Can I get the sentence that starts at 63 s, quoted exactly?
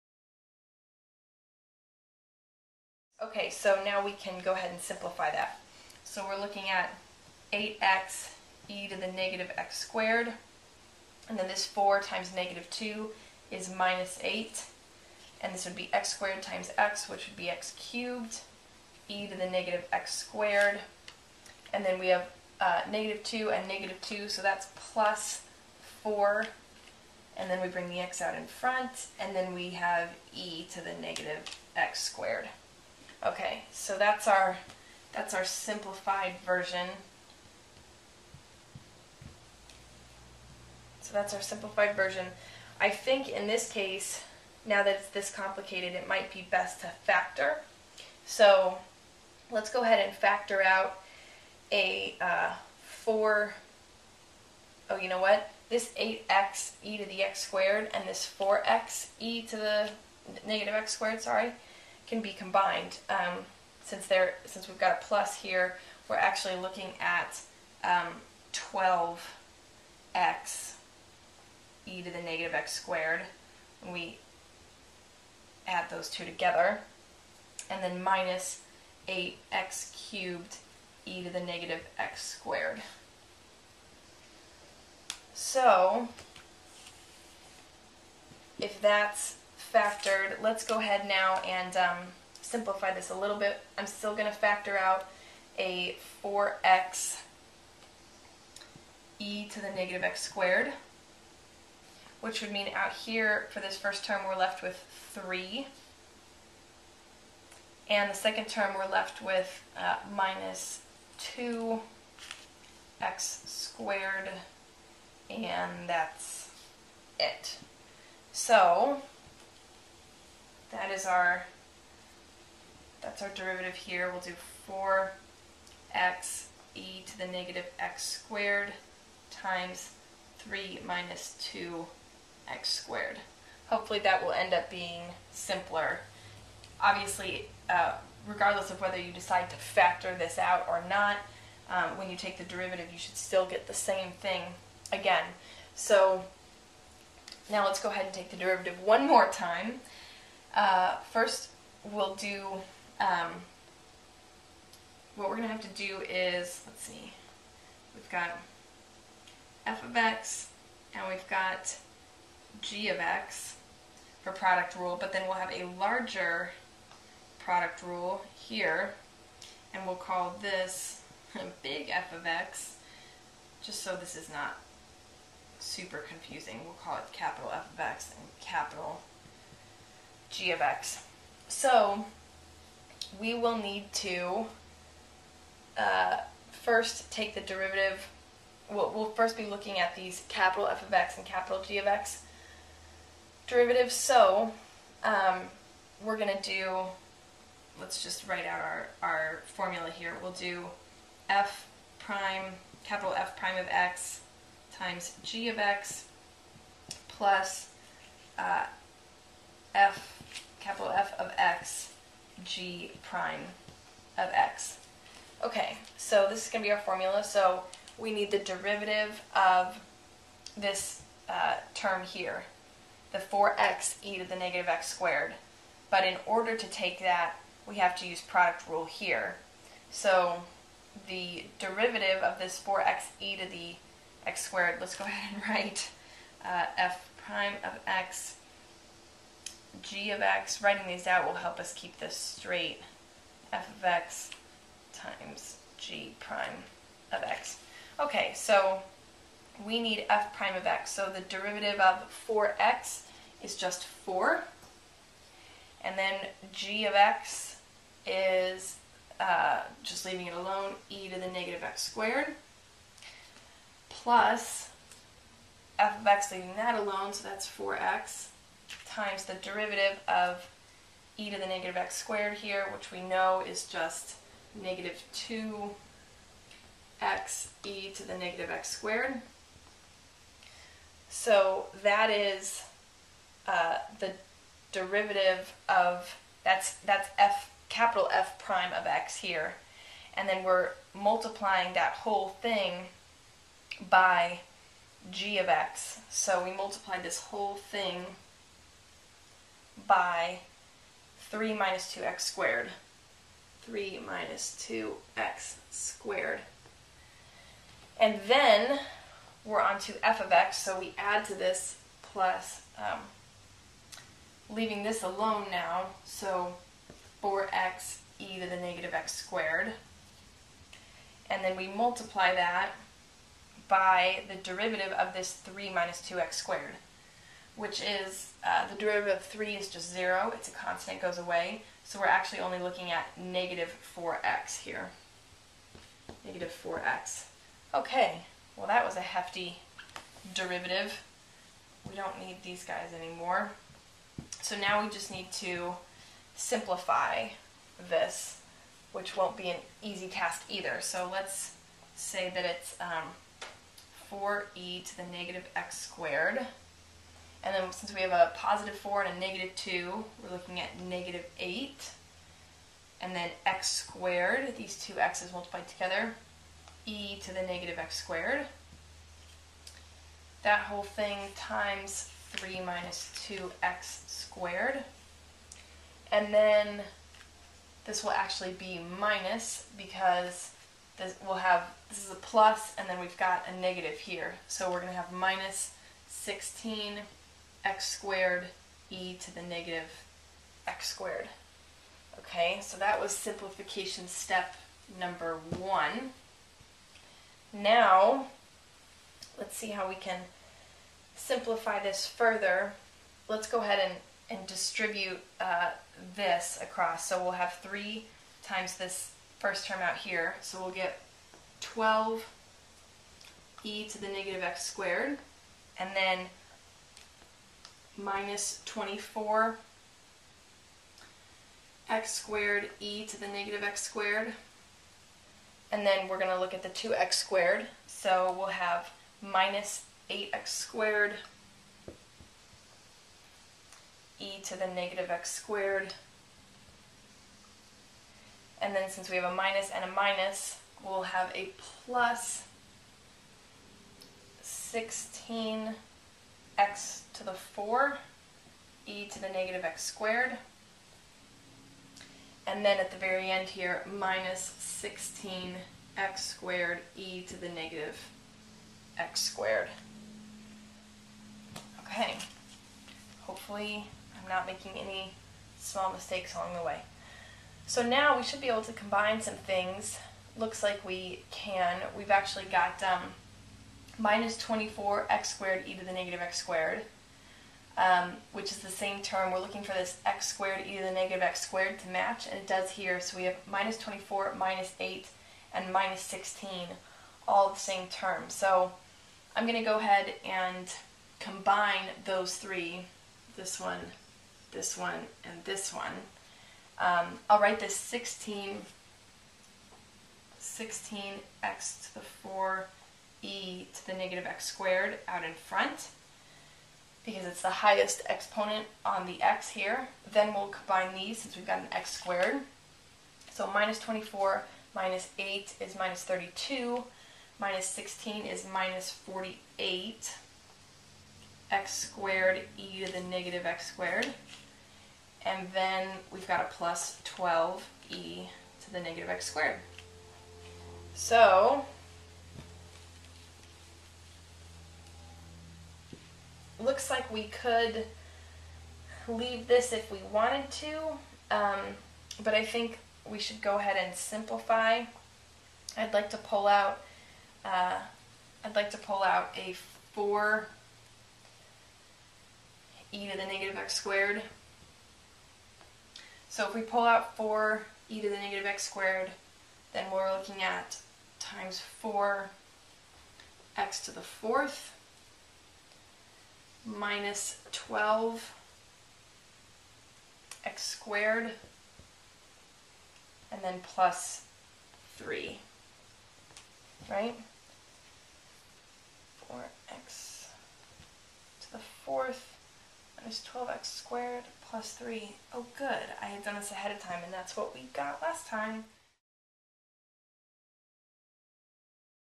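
Um, since there, since we've got a plus here, we're actually looking at um, 12x e to the negative x squared.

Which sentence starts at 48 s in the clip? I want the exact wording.
So let's go ahead and factor out a uh, 4, oh, you know what?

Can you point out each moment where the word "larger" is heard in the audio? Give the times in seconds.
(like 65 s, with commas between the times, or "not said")
165 s.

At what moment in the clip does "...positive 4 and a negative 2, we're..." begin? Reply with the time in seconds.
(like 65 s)
358 s.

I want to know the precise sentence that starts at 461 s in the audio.
Okay, hopefully I'm not making any small mistakes along the way.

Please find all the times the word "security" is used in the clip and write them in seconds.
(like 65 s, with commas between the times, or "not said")
not said.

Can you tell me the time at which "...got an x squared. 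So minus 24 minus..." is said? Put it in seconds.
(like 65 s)
511 s.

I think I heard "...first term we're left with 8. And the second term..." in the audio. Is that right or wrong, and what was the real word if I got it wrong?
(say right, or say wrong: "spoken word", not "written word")
wrong: "3", not "8".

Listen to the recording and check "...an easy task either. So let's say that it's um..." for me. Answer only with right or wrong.
right.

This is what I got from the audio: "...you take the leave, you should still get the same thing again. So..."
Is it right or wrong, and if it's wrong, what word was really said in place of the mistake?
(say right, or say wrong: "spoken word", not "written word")
wrong: "derivative", not "leave".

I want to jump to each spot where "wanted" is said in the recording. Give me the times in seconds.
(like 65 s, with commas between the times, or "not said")
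540 s.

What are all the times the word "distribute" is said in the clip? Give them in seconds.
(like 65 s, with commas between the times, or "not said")
404 s.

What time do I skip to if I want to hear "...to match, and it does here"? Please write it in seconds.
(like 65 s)
481 s.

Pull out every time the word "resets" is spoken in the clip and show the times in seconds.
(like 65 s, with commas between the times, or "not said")
not said.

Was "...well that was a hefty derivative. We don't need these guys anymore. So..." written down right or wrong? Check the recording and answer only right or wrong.
right.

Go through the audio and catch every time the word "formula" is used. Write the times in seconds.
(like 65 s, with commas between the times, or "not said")
199 s, 216 s.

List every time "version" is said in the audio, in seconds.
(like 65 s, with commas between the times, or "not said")
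36 s, 41 s.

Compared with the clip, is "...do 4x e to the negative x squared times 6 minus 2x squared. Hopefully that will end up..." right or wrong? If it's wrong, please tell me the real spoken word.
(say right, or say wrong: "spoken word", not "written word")
wrong: "3", not "6".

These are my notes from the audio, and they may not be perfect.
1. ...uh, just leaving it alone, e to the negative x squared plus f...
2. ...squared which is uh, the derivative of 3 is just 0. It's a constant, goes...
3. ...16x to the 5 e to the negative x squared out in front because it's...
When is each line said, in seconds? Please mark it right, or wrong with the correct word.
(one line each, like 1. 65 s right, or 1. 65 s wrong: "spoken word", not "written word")
1. 259 s right
2. 326 s right
3. 498 s wrong: "4", not "5".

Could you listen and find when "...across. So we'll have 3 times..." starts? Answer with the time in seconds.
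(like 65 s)
406 s.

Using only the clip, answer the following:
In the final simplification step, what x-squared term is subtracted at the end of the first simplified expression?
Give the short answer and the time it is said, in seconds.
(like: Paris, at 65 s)
16x squared, at 385 s.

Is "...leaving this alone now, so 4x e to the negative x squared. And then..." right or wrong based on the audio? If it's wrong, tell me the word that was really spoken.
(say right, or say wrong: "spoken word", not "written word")
right.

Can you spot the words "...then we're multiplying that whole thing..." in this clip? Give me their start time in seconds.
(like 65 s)
290 s.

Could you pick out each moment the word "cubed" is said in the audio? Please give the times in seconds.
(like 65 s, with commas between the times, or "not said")
17 s, 80 s.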